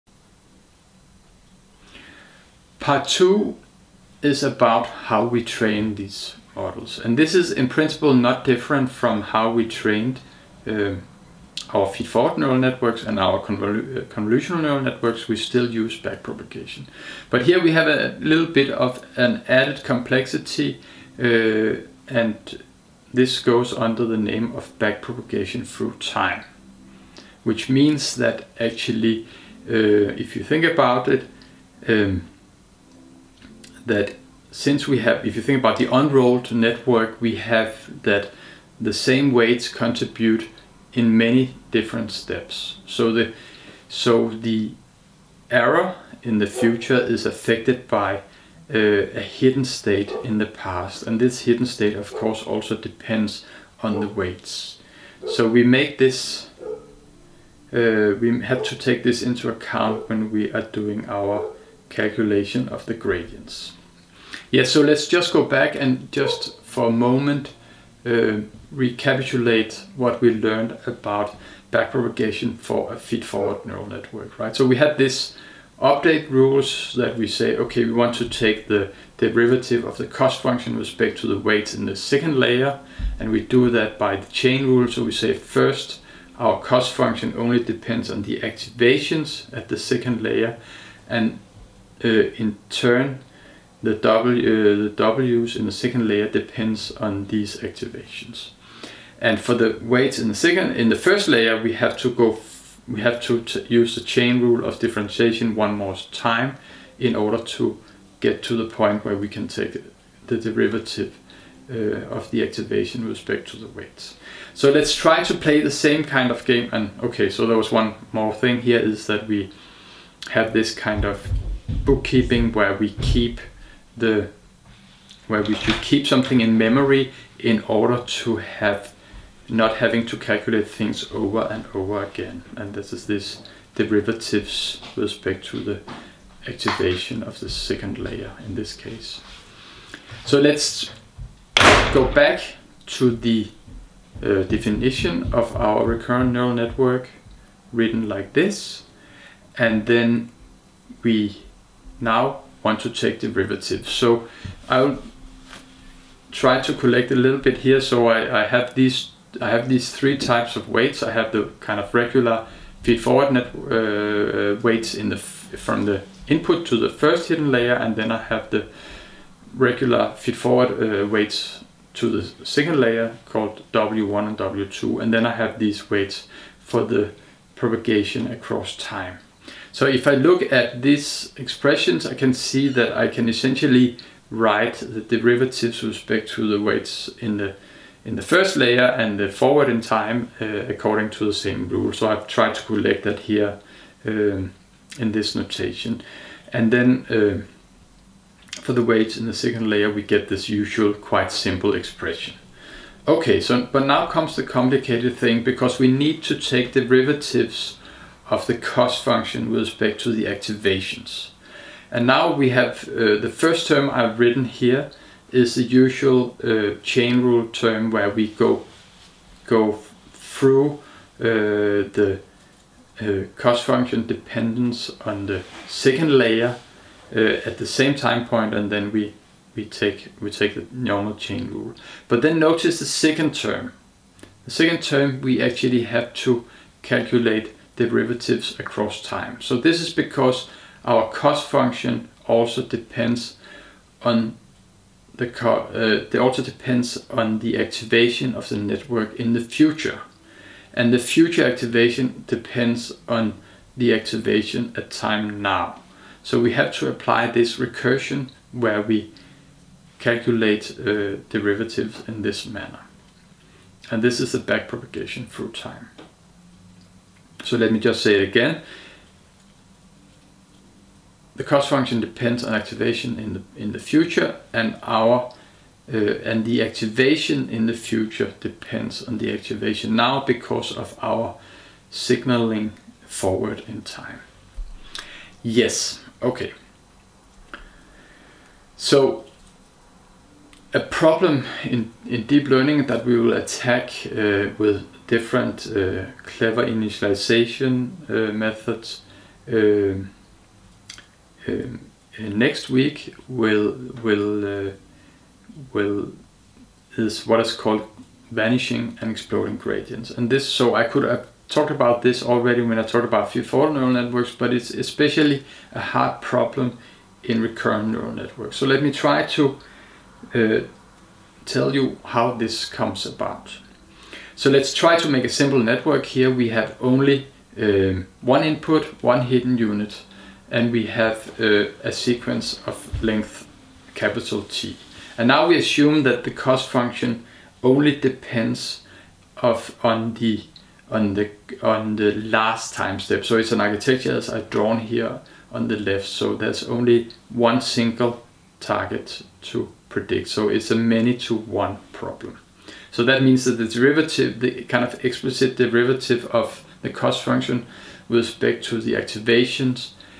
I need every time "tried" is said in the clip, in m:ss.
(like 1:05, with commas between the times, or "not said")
3:12.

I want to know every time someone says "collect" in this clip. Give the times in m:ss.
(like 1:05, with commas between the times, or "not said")
2:36, 3:12.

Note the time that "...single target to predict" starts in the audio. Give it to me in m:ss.
5:47.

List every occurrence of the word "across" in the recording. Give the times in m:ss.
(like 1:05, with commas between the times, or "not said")
2:58, 3:58.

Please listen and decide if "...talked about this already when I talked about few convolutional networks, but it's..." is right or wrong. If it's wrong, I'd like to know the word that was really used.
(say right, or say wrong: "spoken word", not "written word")
wrong: "neural", not "convolutional".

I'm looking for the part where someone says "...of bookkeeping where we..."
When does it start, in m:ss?
2:01.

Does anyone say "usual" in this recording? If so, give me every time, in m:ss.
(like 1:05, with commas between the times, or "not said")
3:20, 3:35.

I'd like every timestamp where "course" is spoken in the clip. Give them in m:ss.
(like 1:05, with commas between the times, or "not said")
0:52.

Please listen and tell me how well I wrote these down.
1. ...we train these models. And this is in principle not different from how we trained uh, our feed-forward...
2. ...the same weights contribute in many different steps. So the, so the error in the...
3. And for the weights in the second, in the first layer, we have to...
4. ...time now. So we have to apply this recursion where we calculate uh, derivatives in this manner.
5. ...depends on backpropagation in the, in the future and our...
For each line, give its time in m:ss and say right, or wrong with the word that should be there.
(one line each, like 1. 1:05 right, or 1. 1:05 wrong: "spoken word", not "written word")
1. 0:05 right
2. 0:38 right
3. 1:39 right
4. 4:14 right
5. 4:31 wrong: "activation", not "backpropagation".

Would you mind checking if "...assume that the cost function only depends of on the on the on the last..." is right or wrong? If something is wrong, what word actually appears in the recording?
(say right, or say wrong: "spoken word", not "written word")
right.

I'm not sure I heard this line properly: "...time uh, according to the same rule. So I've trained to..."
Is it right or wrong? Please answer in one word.
wrong.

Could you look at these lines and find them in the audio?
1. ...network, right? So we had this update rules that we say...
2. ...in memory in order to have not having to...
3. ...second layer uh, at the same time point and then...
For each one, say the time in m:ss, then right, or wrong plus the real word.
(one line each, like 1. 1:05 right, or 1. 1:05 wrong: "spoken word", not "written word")
1. 1:13 right
2. 2:06 right
3. 3:45 right.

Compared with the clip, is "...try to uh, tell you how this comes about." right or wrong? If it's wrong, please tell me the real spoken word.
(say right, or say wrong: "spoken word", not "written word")
right.